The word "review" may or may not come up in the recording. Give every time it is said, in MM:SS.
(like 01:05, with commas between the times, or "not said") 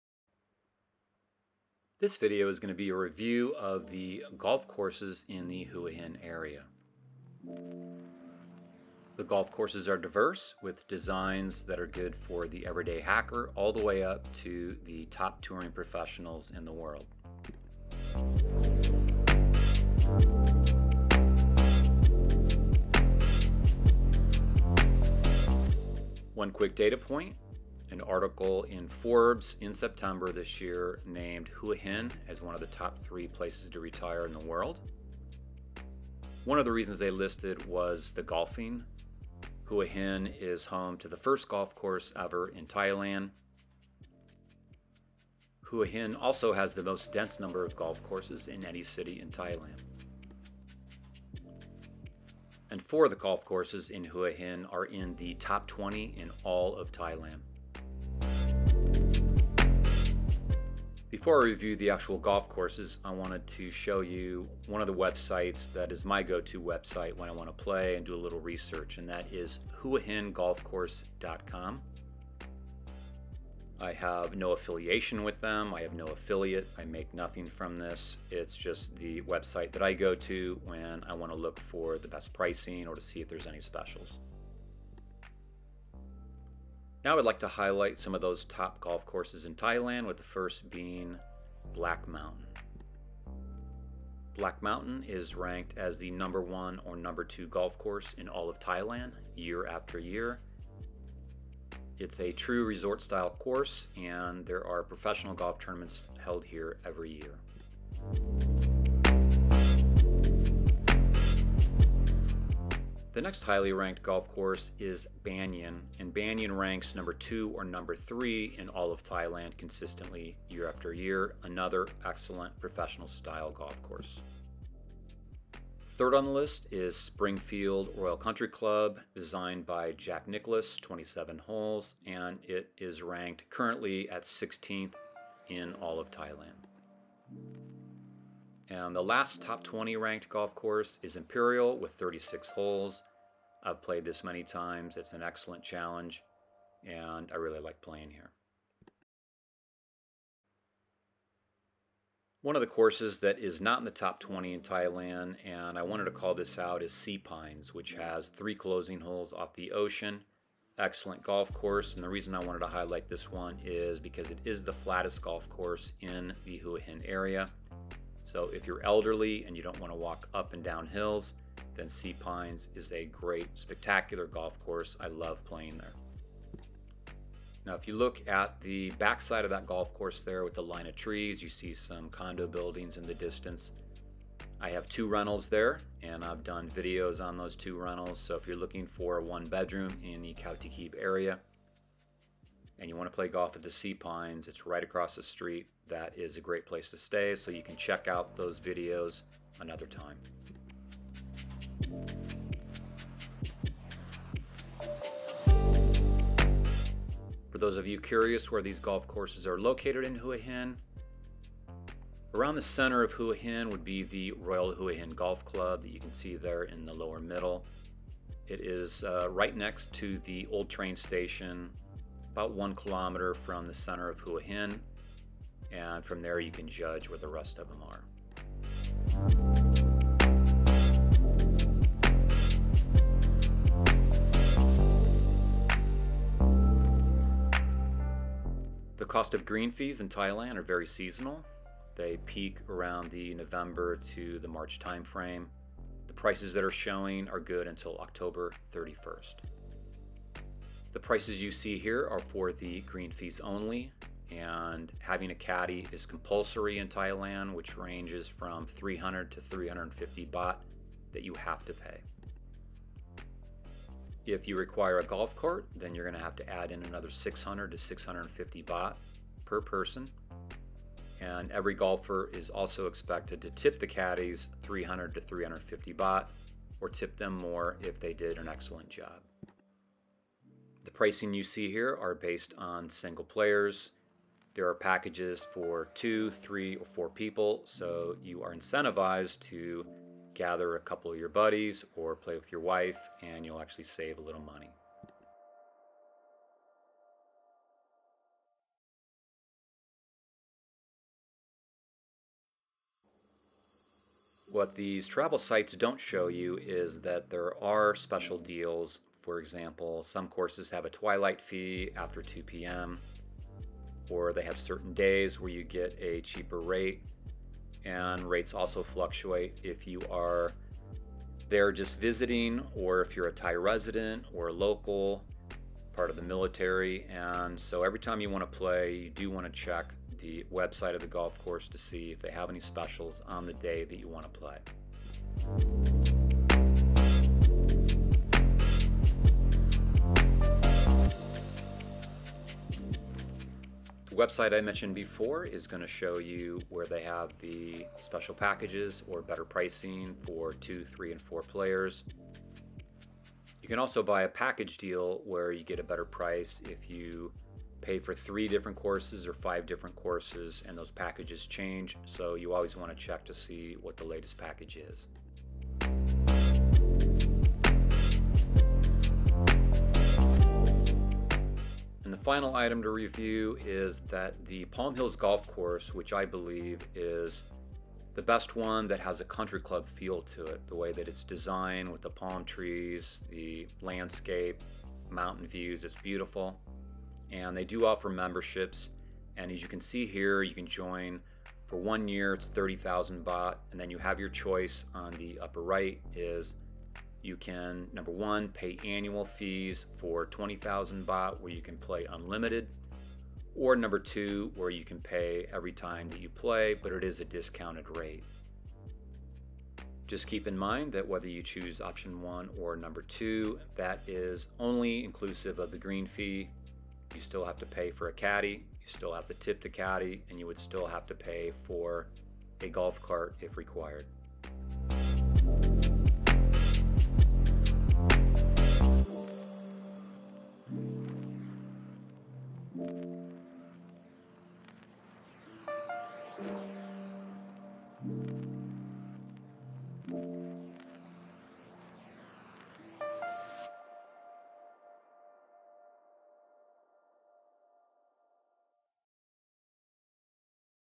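00:02, 01:01, 06:12.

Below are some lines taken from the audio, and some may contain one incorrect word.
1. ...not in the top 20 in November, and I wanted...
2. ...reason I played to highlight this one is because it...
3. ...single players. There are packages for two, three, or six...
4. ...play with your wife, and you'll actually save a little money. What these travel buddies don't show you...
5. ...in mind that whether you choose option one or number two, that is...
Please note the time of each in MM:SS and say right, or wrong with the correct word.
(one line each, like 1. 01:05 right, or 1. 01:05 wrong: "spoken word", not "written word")
1. 02:33 wrong: "Thailand", not "November"
2. 02:42 wrong: "wanted", not "played"
3. 04:42 wrong: "four", not "six"
4. 04:52 wrong: "sites", not "buddies"
5. 06:50 right.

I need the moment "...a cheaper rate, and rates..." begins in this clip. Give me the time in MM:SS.
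05:16.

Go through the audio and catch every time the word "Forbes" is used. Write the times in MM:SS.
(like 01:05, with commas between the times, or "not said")
00:28.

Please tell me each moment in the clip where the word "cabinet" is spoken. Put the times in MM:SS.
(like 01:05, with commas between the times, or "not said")
not said.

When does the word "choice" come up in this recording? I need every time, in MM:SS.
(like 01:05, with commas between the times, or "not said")
06:34.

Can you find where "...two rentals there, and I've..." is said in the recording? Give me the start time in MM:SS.
03:04.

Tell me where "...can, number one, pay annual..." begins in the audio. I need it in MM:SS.
06:37.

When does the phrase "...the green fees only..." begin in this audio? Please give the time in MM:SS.
04:12.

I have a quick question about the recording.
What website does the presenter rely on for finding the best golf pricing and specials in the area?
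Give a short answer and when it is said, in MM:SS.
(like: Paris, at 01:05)
huahingolfcourse.com, at 01:09.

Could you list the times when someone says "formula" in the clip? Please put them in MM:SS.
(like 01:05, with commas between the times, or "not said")
not said.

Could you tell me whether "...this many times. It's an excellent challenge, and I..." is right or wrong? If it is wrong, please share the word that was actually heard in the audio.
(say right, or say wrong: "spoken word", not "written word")
right.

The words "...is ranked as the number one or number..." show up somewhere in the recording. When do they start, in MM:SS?
01:35.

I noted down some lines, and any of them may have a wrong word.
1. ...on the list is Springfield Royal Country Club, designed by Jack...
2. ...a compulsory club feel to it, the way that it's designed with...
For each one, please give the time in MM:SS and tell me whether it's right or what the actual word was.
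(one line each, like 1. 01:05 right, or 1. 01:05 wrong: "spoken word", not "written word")
1. 02:06 right
2. 06:19 wrong: "country", not "compulsory".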